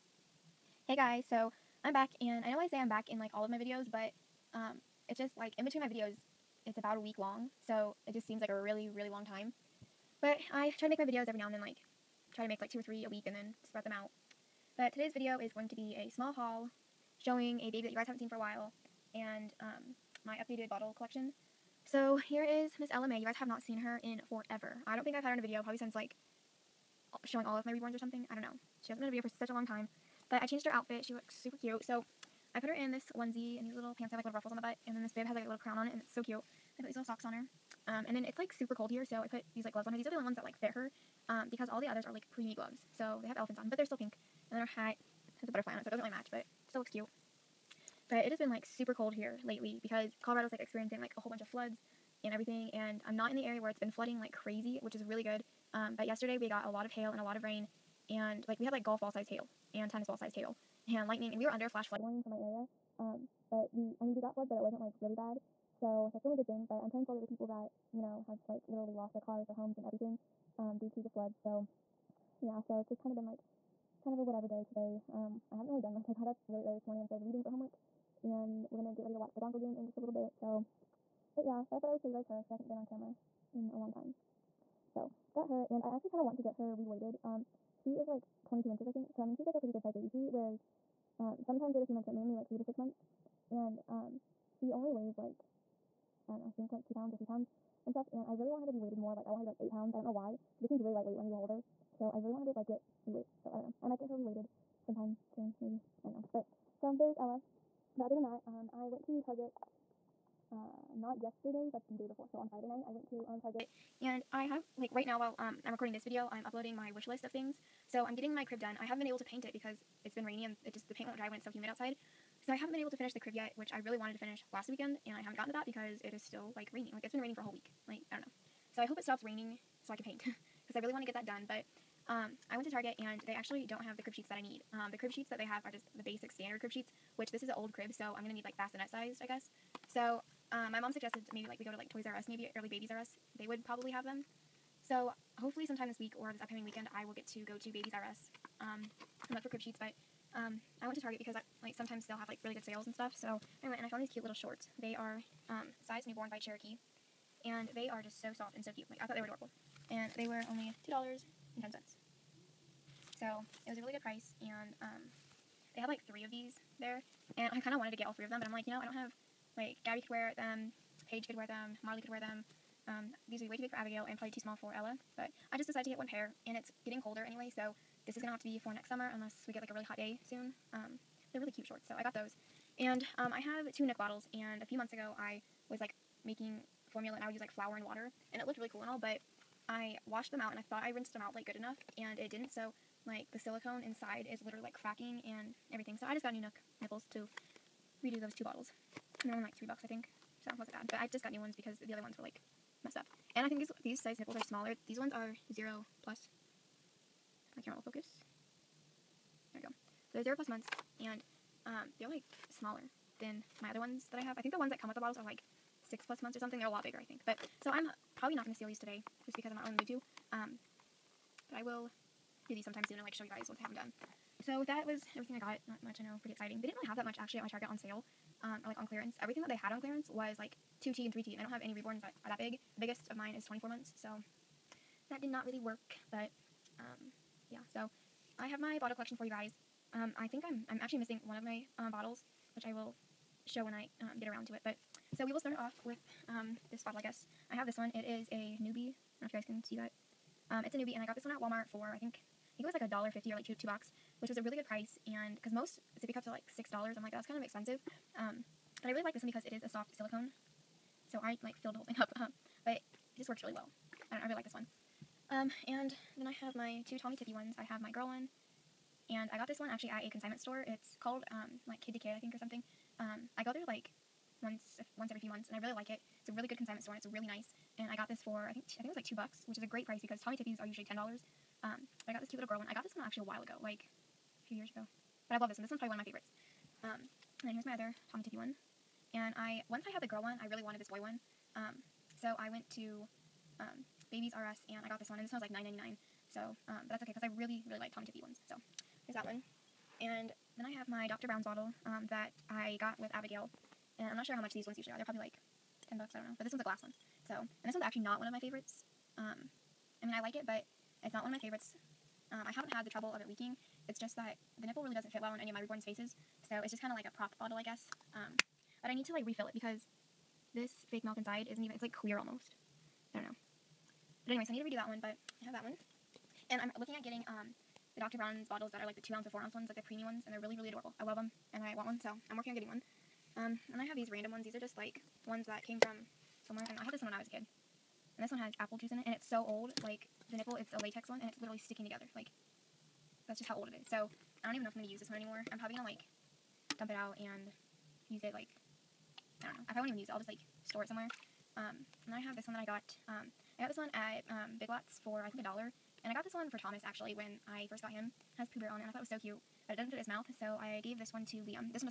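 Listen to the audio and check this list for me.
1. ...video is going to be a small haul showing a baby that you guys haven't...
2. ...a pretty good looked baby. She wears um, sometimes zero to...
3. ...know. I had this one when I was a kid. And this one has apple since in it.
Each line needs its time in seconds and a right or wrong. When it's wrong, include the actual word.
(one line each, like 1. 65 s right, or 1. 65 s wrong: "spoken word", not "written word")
1. 15 s right
2. 89 s wrong: "sized", not "looked"
3. 336 s wrong: "juice", not "since".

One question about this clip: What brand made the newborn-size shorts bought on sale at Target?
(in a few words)
Cherokee.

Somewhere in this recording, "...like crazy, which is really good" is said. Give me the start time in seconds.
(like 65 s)
54 s.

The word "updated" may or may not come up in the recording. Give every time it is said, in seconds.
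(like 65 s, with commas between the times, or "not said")
20 s.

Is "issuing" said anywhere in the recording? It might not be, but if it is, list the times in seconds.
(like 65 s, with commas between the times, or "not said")
not said.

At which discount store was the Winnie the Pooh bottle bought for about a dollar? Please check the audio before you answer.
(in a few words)
Big Lots.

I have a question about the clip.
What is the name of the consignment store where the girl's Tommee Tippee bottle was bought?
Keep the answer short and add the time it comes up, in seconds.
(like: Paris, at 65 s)
Kid to Kid, at 271 s.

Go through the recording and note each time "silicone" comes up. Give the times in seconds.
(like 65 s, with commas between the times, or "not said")
193 s, 259 s.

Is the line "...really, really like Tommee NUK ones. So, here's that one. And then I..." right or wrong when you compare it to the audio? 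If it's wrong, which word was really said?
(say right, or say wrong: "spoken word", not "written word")
wrong: "Tippee", not "NUK".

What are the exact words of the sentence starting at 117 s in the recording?
So I'm getting my crib done.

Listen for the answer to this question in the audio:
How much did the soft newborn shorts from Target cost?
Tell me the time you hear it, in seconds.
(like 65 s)
160 s.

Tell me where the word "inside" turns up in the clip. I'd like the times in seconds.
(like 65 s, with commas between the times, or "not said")
193 s, 321 s.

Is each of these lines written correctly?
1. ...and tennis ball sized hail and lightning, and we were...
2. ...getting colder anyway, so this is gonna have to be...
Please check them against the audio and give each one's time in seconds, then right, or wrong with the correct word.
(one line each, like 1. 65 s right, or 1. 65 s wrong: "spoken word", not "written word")
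1. 59 s right
2. 176 s right.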